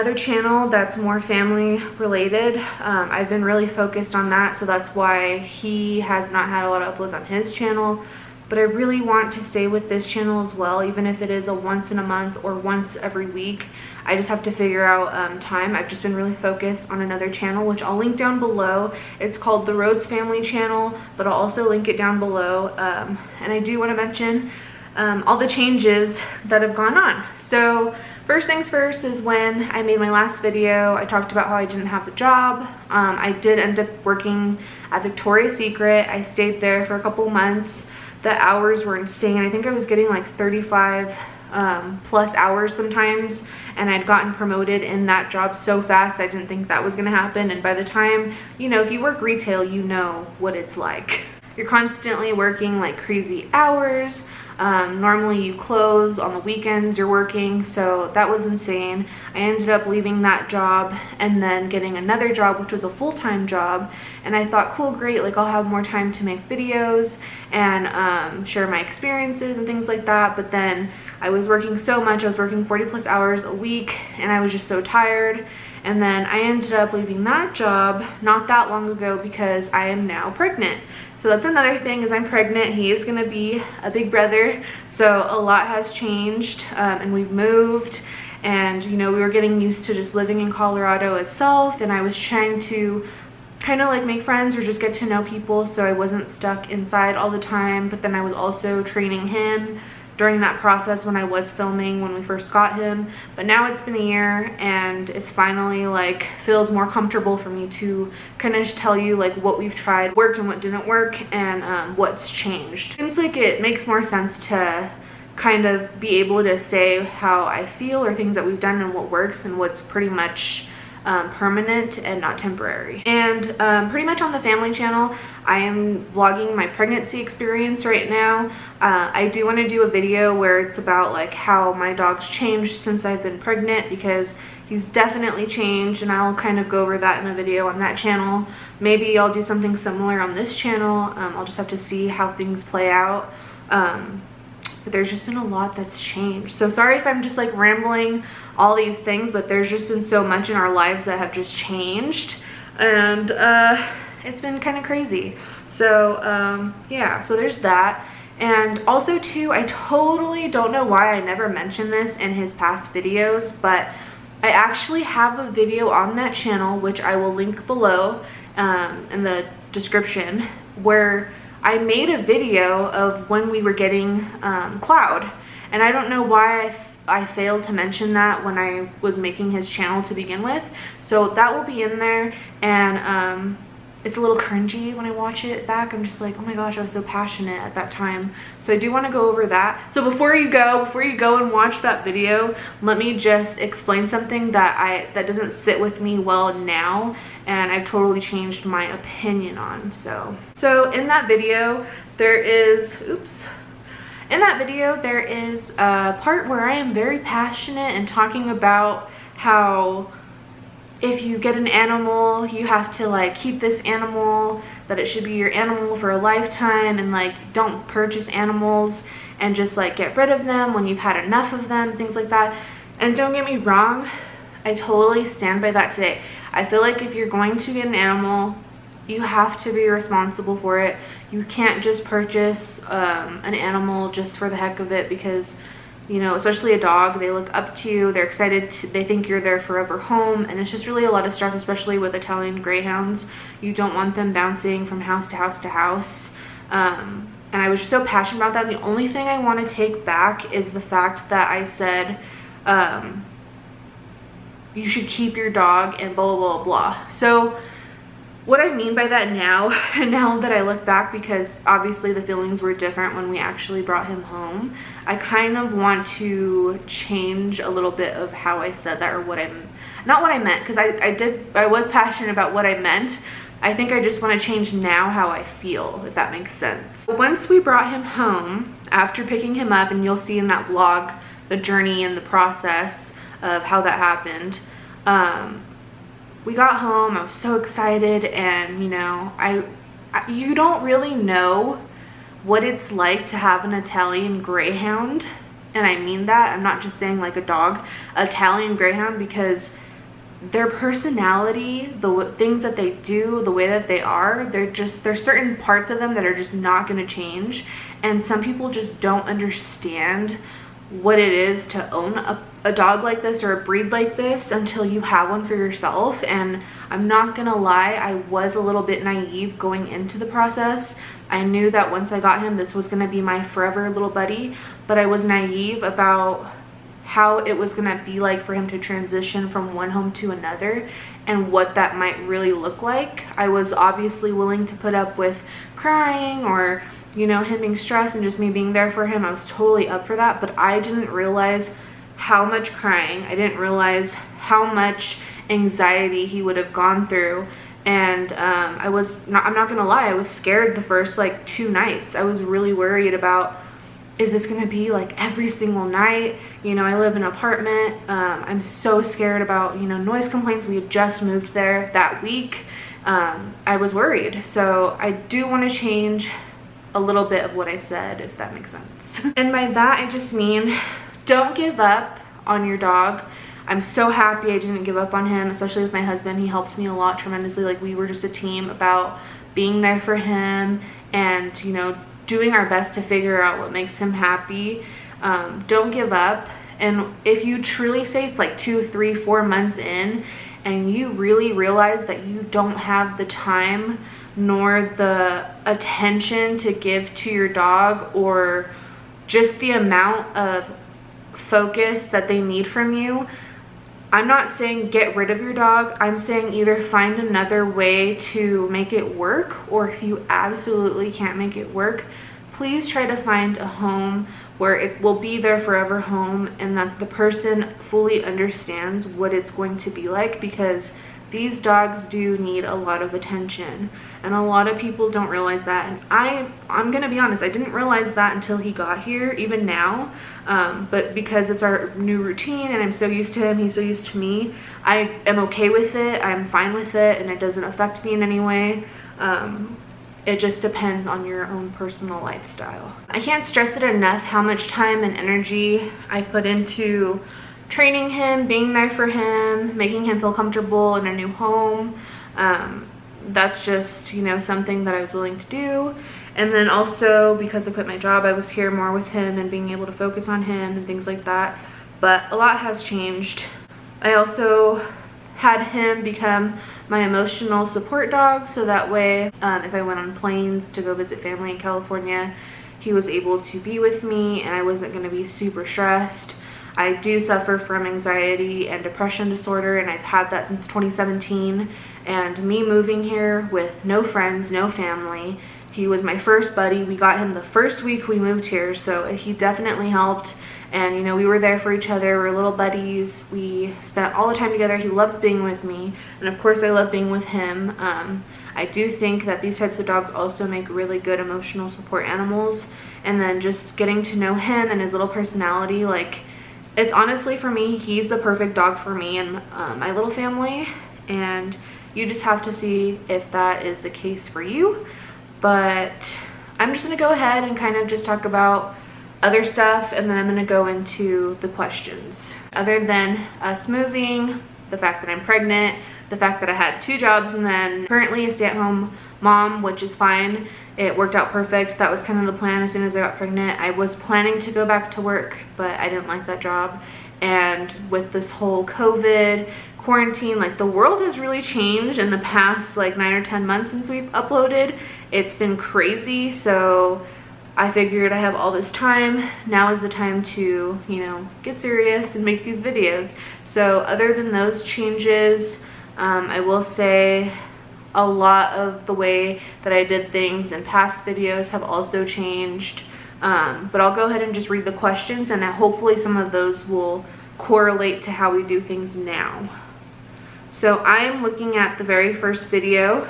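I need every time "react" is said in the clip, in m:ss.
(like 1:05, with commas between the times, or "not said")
not said.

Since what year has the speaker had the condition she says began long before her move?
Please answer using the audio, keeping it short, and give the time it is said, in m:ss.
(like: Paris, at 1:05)
2017, at 8:00.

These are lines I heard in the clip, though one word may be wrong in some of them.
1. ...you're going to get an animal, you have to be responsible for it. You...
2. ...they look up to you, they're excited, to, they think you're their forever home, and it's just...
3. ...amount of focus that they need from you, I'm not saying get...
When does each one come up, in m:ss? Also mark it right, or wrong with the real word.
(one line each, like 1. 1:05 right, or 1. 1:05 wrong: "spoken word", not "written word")
1. 3:47 right
2. 3:57 right
3. 6:39 right.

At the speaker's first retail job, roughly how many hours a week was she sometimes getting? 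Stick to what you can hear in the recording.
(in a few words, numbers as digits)
35.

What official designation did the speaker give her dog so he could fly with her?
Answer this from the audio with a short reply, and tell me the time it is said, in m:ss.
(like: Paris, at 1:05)
emotional support dog, at 7:46.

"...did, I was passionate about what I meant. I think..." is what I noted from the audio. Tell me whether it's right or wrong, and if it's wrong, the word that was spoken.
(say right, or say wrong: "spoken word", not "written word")
right.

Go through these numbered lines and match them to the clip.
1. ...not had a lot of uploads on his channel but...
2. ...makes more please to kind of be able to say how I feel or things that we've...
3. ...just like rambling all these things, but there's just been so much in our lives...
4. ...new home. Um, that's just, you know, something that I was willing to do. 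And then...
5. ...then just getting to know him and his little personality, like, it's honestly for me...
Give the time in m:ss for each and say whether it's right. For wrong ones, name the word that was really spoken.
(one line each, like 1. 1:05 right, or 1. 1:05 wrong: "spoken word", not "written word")
1. 0:06 right
2. 1:53 wrong: "sense", not "please"
3. 2:27 right
4. 7:31 right
5. 8:23 right.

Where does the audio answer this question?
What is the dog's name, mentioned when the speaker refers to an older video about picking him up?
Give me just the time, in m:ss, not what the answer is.
2:54.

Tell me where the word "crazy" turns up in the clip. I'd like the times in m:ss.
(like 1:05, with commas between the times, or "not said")
0:52, 2:34, 9:05.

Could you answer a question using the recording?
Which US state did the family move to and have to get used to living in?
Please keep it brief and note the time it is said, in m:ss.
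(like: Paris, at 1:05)
Colorado, at 1:30.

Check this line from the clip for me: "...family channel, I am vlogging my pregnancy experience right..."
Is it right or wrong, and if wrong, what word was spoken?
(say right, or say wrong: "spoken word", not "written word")
right.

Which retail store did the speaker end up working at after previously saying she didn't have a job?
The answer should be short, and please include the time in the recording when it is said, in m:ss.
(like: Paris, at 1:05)
Victoria's Secret, at 0:35.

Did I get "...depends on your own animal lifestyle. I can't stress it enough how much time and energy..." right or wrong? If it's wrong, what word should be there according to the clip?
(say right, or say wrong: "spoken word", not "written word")
wrong: "personal", not "animal".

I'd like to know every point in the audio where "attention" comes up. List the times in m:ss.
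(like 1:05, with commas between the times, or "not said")
6:35, 7:03.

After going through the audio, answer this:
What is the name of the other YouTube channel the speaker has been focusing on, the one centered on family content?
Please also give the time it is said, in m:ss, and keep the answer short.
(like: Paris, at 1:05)
Rhodes Family Channel, at 0:19.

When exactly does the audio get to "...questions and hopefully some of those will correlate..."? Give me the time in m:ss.
9:24.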